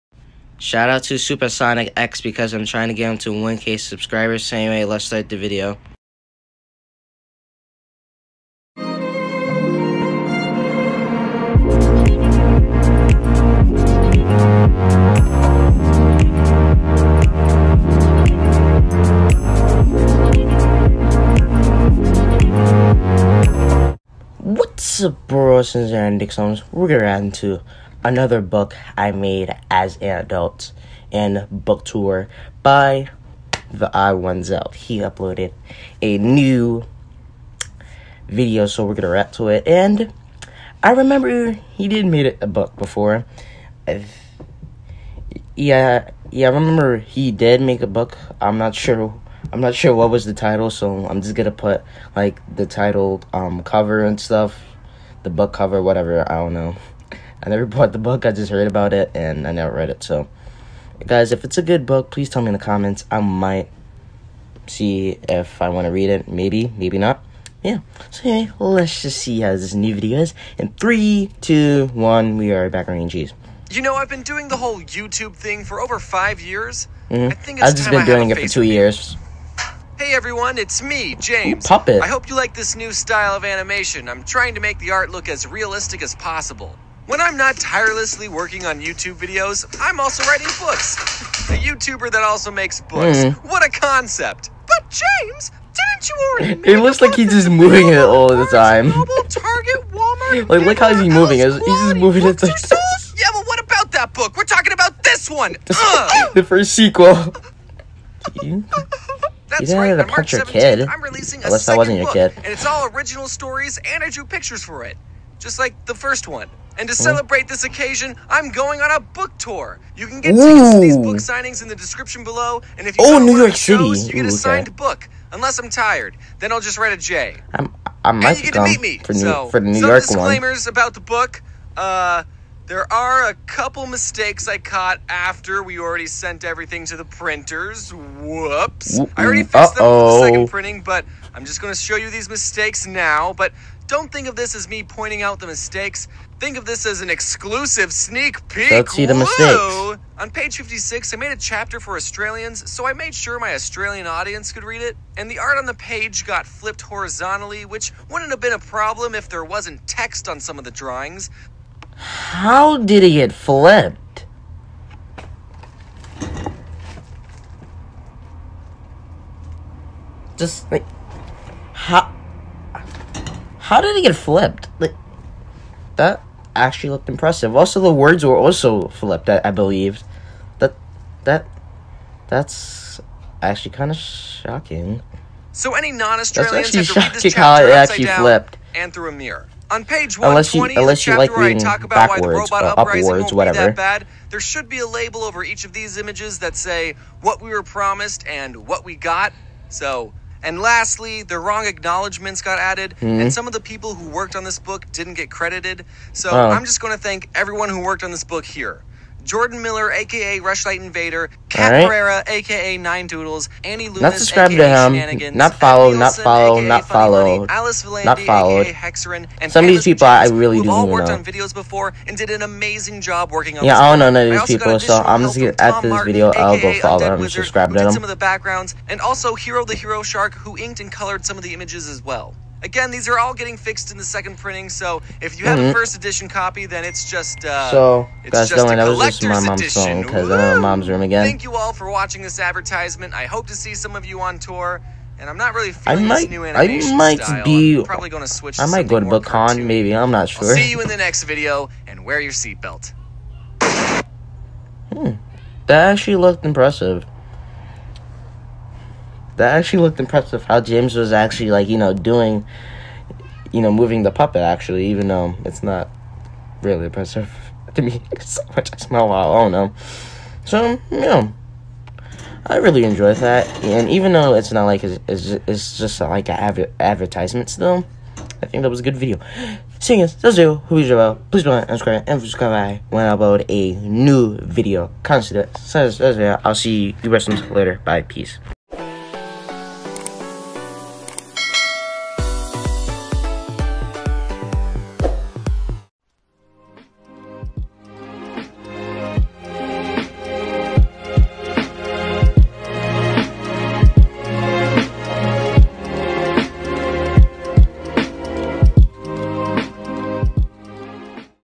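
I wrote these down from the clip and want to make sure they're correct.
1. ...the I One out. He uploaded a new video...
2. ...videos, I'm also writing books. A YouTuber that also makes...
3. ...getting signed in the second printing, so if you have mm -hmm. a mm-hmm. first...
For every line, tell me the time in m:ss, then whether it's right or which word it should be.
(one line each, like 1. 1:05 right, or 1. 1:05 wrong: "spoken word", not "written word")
1. 0:33 right
2. 1:29 right
3. 3:53 wrong: "fixed", not "signed".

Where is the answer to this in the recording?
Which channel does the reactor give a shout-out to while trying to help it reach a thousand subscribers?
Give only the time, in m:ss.
0:01.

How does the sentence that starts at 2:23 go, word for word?
But don't think of this as me pointing out the mistakes.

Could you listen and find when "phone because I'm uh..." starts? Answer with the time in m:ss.
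3:59.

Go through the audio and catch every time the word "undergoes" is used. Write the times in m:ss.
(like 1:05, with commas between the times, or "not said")
not said.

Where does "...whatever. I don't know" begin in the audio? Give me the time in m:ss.
0:55.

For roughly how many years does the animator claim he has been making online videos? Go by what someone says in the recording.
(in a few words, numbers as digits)
5.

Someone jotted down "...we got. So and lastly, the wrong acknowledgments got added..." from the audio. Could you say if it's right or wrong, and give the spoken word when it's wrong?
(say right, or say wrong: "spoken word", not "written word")
right.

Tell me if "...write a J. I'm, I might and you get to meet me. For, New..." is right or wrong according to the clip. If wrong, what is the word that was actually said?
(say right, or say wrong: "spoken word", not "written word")
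right.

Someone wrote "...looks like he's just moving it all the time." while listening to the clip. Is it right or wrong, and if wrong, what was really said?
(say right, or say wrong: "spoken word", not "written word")
right.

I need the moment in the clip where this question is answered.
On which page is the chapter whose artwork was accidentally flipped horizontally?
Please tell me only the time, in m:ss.
2:30.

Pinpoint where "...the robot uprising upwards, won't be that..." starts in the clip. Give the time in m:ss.
3:12.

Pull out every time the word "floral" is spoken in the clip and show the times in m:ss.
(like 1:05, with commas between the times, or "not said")
not said.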